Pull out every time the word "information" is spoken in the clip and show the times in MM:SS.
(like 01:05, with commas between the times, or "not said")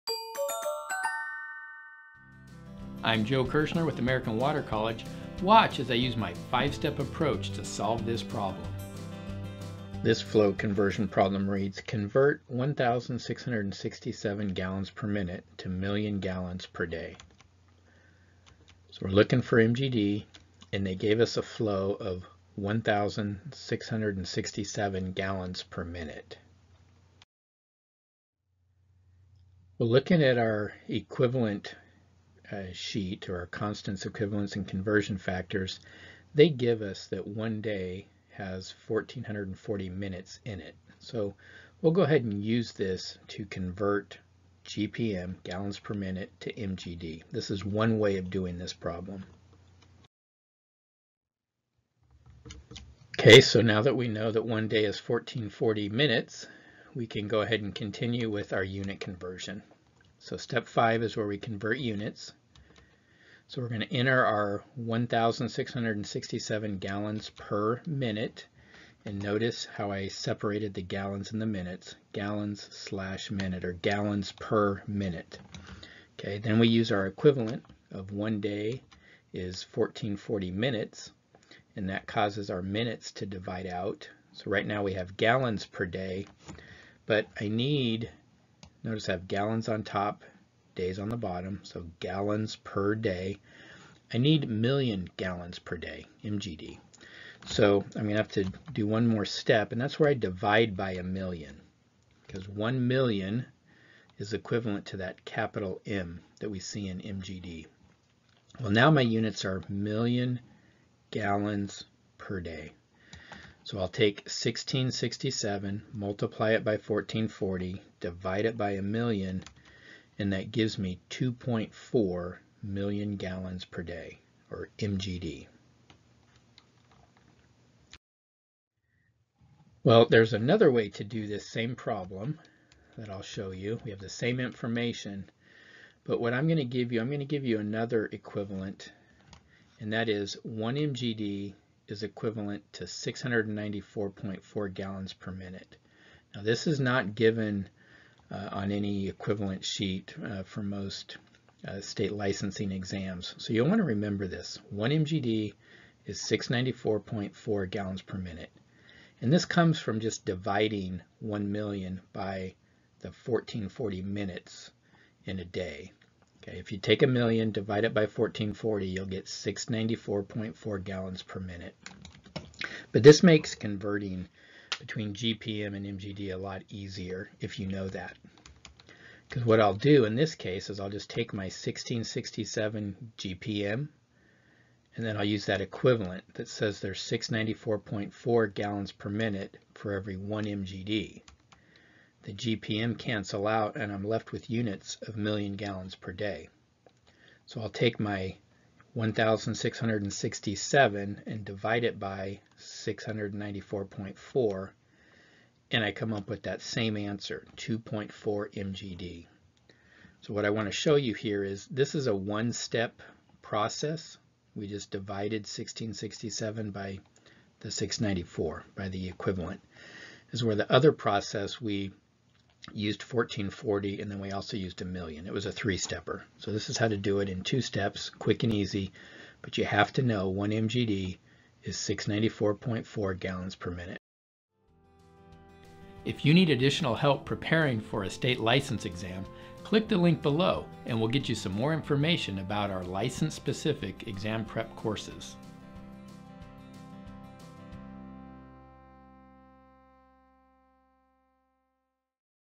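02:14, 04:01.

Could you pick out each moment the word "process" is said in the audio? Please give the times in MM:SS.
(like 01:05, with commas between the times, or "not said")
03:33, 03:40.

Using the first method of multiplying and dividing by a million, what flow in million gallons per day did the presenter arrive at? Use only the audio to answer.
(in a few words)
2.4.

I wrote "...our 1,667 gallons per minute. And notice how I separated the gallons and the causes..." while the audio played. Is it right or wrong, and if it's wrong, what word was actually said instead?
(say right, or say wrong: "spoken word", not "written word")
wrong: "minutes", not "causes".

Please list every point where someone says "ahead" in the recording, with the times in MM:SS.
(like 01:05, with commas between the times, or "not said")
00:42, 00:57.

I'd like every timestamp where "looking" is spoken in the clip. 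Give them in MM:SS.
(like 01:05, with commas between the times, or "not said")
00:19, 00:29.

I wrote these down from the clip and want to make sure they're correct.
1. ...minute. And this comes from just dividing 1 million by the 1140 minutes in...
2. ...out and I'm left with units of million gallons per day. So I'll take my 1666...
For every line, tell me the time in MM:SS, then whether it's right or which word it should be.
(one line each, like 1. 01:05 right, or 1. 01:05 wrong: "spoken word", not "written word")
1. 02:38 wrong: "1440", not "1140"
2. 03:13 wrong: "1667", not "1666".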